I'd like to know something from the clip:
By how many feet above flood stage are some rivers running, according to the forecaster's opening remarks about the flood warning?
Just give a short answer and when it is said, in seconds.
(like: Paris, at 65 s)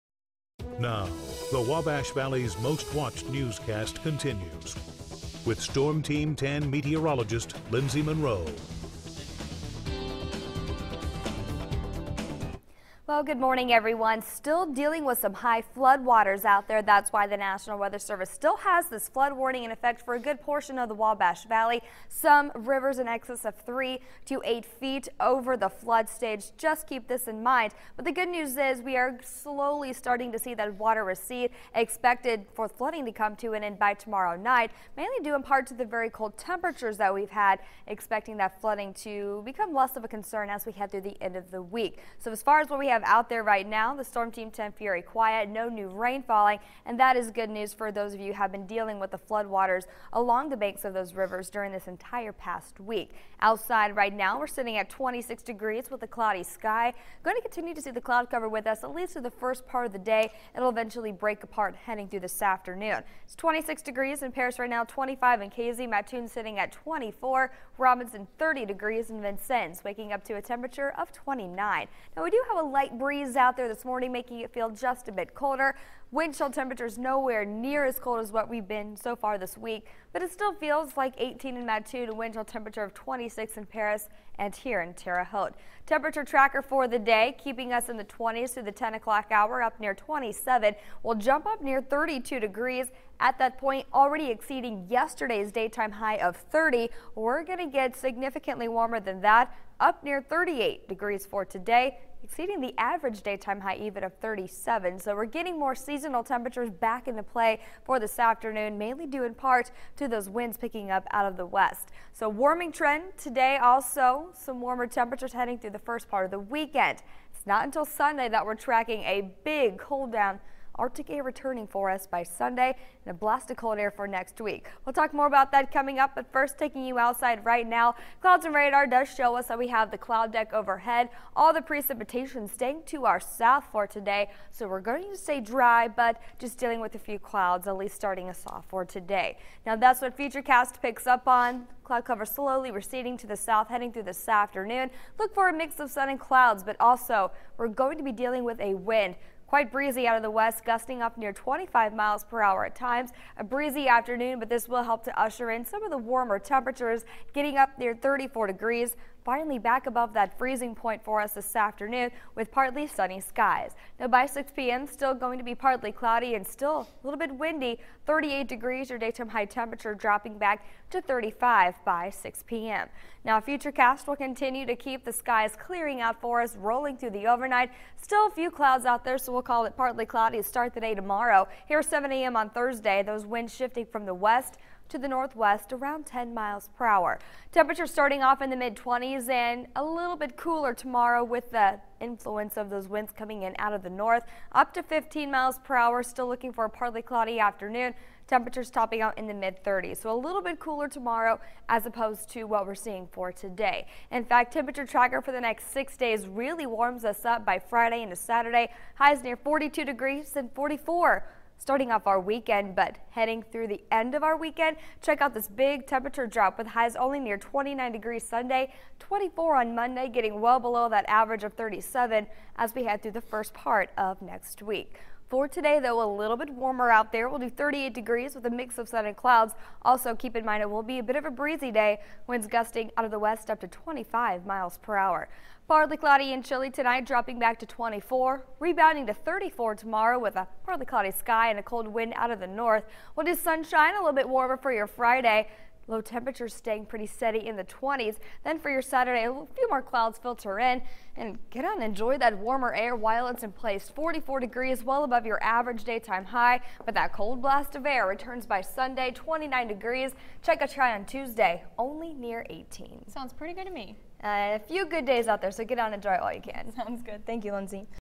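3 to 8 feet, at 23 s.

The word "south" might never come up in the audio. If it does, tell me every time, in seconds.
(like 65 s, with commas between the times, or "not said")
133 s, 143 s.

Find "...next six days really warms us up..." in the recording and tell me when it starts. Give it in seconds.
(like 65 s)
205 s.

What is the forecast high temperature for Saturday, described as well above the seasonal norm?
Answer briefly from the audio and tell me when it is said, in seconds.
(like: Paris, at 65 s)
44 degrees, at 253 s.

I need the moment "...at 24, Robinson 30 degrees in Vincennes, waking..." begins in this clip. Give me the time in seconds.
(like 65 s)
66 s.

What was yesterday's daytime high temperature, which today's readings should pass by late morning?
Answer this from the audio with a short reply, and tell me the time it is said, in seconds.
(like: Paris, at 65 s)
30, at 94 s.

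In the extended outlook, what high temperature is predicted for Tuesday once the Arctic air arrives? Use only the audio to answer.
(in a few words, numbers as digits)
18.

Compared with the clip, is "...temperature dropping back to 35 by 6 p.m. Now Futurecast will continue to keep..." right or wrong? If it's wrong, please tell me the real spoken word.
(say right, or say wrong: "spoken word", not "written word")
right.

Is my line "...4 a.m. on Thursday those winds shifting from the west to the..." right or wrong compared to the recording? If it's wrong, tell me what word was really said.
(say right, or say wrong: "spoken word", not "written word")
wrong: "7", not "4".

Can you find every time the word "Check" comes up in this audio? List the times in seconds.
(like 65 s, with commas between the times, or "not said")
215 s, 260 s.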